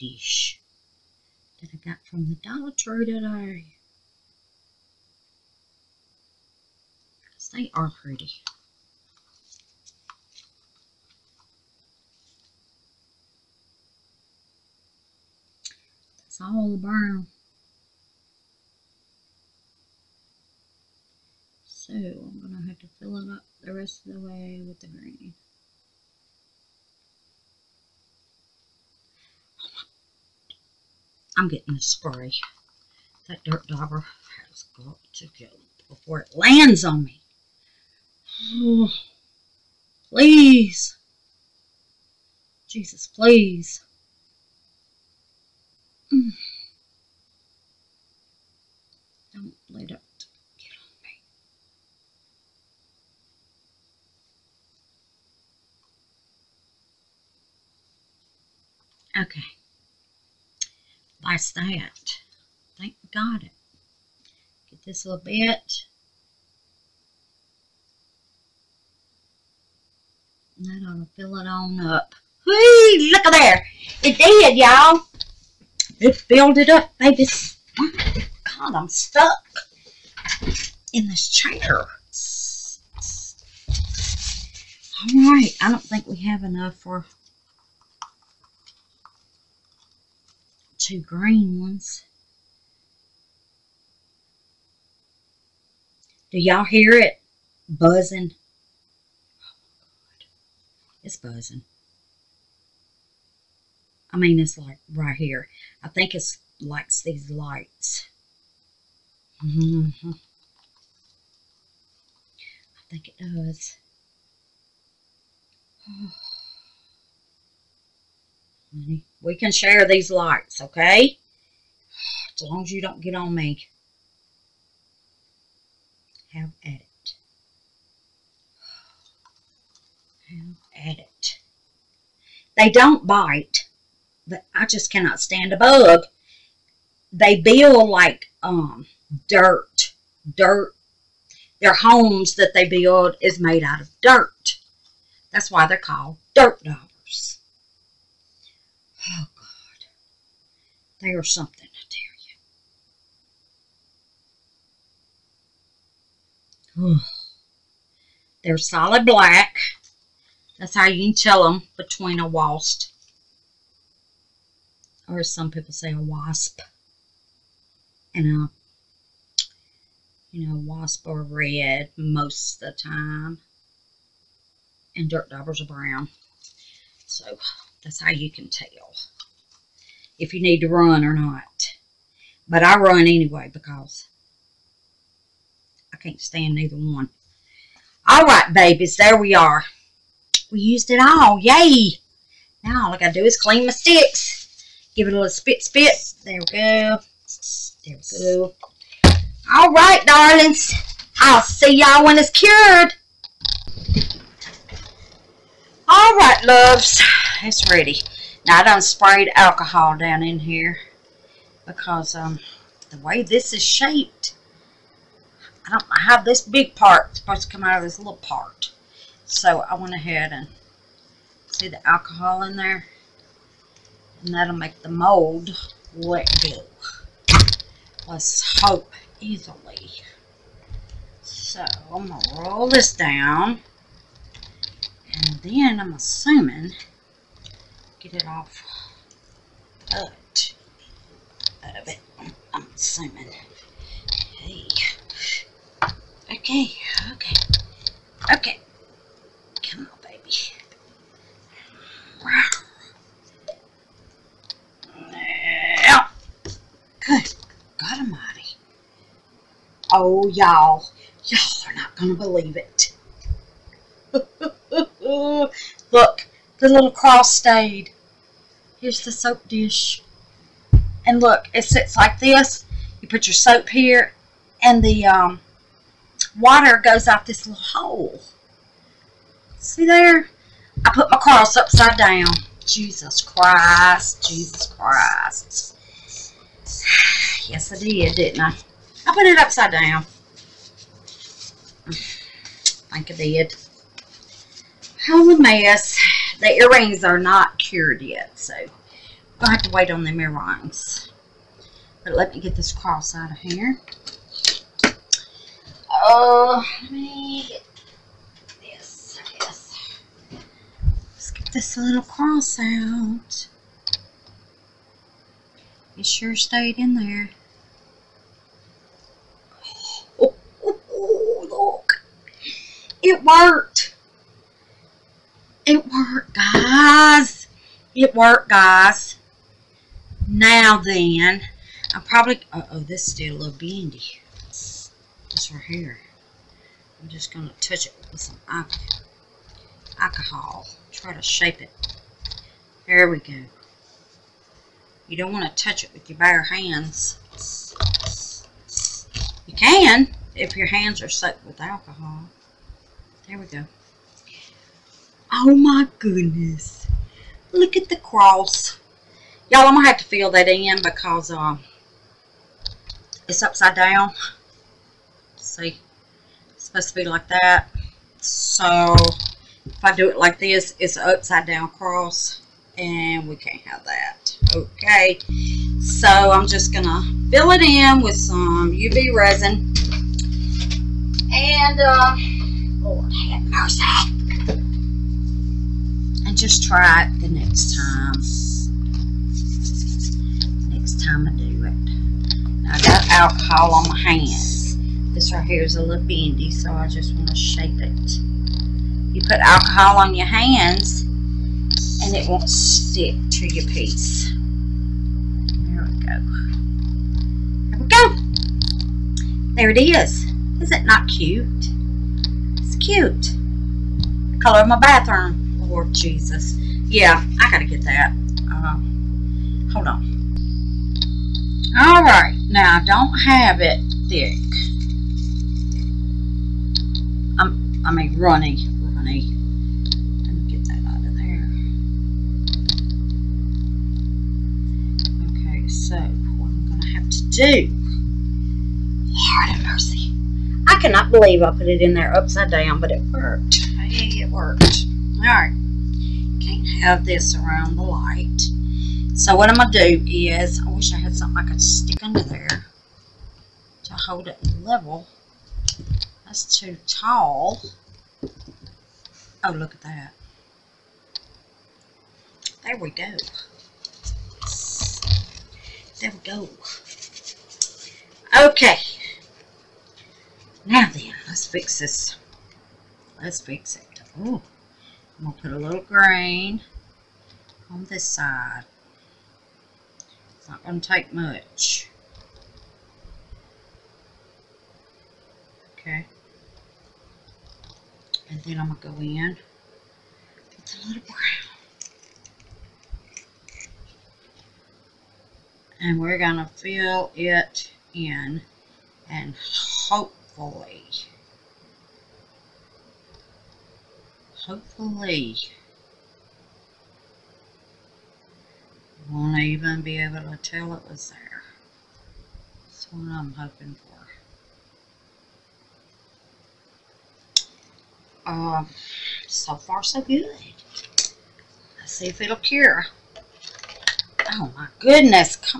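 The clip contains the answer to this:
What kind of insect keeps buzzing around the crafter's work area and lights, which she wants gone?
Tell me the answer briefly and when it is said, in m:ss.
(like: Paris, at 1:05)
dirt dauber, at 0:33.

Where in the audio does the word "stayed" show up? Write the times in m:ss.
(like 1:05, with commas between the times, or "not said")
4:27, 5:16.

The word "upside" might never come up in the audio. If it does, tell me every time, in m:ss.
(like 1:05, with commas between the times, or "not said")
4:41, 4:49, 6:03, 6:11, 7:22.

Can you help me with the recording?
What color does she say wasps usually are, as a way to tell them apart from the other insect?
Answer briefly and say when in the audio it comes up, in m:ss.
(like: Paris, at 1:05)
red, at 2:51.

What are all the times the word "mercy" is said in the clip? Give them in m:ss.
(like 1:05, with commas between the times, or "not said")
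6:23, 7:19.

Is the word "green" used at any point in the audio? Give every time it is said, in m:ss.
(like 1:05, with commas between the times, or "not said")
0:24, 1:31.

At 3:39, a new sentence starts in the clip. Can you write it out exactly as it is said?
So I went ahead and see the alcohol in there, and that'll make the mold let go.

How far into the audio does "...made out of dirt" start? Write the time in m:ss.
2:23.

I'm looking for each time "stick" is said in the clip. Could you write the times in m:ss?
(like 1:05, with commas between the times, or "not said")
3:13, 6:42, 7:31.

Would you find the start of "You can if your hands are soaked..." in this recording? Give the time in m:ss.
5:49.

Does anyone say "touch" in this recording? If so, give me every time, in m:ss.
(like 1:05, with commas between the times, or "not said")
5:37, 5:45.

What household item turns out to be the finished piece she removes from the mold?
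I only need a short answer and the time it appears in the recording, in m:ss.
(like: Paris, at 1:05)
soap dish, at 4:29.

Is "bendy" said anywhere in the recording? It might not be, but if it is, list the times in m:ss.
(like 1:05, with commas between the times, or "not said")
5:33, 6:36.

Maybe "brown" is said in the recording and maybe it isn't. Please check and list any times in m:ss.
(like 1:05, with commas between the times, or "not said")
0:16, 2:55, 8:11.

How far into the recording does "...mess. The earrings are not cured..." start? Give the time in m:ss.
4:55.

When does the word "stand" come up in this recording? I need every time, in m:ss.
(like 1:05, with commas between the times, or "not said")
2:15, 3:06.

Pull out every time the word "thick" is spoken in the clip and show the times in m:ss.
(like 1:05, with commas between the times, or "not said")
7:04.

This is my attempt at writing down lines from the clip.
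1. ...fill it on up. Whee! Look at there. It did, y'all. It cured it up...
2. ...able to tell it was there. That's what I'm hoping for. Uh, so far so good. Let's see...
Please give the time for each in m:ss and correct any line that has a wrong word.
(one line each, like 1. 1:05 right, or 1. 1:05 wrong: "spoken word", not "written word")
1. 1:11 wrong: "filled", not "cured"
2. 8:30 right.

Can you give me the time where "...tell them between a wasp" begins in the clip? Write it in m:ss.
2:41.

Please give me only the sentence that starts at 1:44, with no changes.
I mean, it's like right here.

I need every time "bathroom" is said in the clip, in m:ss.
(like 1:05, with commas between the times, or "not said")
6:54.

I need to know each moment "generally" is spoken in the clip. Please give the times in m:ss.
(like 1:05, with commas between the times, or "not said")
not said.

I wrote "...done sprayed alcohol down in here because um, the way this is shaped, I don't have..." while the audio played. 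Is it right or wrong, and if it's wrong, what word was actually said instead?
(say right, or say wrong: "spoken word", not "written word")
right.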